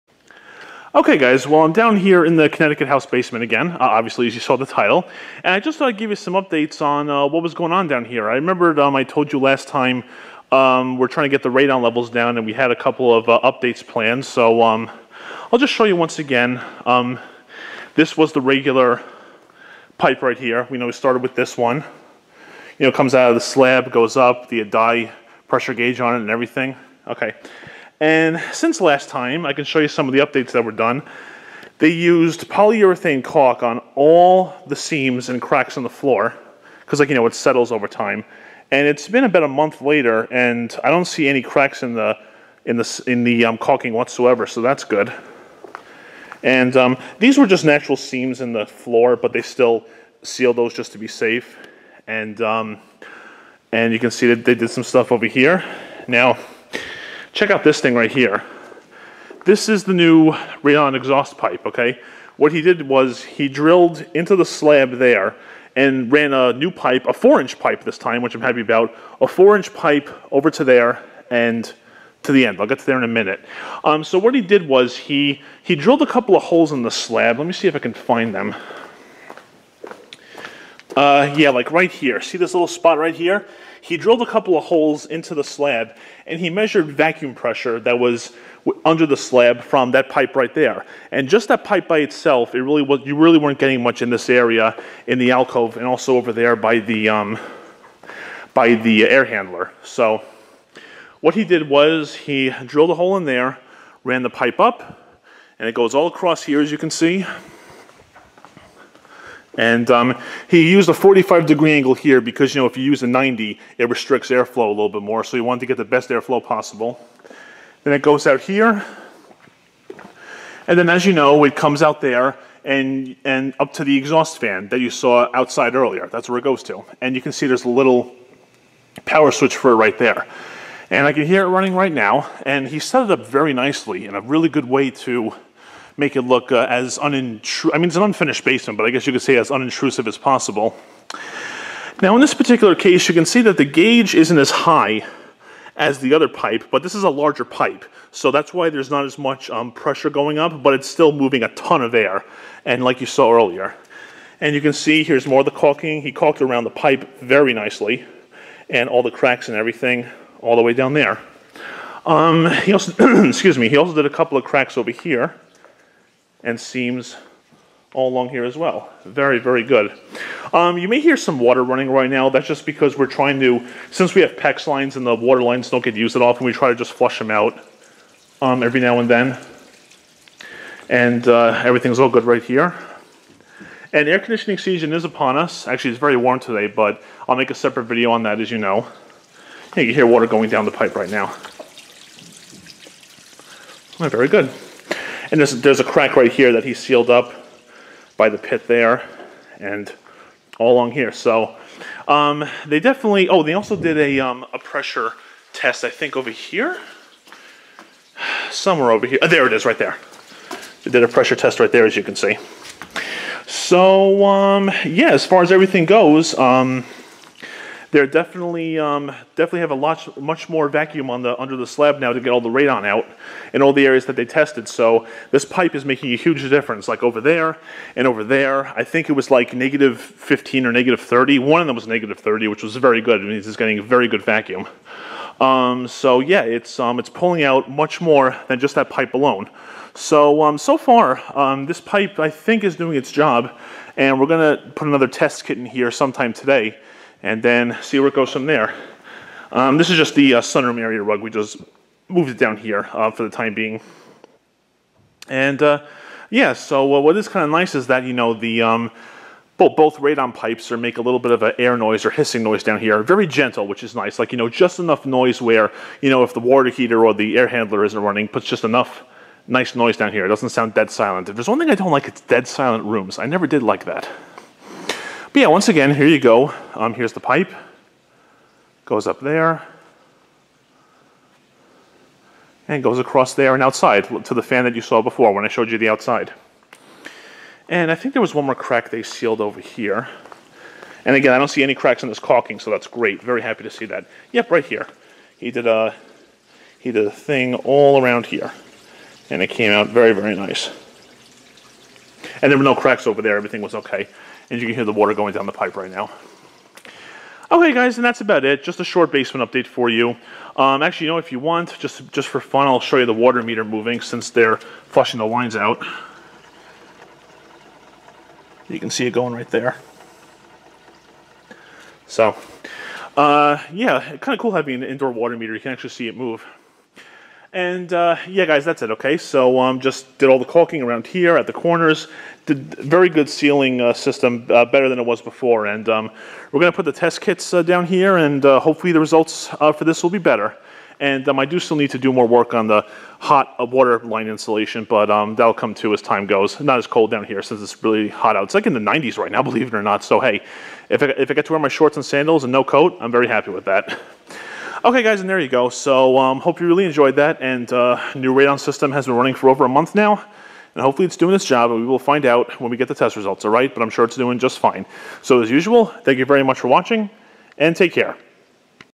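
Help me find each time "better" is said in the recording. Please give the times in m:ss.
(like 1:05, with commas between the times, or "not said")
5:34, 5:40.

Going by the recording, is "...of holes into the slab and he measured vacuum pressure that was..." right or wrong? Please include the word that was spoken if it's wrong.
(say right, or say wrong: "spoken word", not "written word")
right.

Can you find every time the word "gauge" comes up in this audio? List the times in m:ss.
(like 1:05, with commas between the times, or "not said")
0:25, 2:23.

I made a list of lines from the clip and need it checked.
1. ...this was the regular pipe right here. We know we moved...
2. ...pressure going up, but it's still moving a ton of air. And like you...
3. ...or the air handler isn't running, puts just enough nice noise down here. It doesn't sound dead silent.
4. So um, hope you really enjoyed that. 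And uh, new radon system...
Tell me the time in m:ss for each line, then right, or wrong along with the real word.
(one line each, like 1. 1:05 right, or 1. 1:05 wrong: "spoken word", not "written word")
1. 0:17 wrong: "started", not "moved"
2. 2:29 right
3. 4:27 right
4. 5:55 right.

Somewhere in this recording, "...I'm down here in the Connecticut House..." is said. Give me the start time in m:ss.
0:01.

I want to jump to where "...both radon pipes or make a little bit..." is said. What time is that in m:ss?
4:19.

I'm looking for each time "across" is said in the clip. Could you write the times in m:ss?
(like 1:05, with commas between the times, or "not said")
1:46, 4:42.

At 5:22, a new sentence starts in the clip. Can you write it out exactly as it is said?
So, uh, yeah, kind of cool having an indoor water meter.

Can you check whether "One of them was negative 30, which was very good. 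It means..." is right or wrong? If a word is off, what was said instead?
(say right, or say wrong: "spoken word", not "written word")
right.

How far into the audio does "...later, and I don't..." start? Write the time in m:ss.
0:39.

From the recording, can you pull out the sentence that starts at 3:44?
So this pipe is making a huge difference.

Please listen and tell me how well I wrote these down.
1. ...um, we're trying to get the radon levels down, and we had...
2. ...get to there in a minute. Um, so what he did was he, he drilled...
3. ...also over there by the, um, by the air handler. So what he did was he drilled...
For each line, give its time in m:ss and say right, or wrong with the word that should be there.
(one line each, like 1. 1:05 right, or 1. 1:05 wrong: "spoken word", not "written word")
1. 0:10 right
2. 1:12 right
3. 1:35 right.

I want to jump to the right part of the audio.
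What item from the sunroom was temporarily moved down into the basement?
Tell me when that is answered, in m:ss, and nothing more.
4:11.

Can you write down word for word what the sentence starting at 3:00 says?
And uh, everything's all good right here.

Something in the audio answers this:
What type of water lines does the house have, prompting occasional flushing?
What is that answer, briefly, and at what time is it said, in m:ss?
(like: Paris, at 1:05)
PEX, at 2:54.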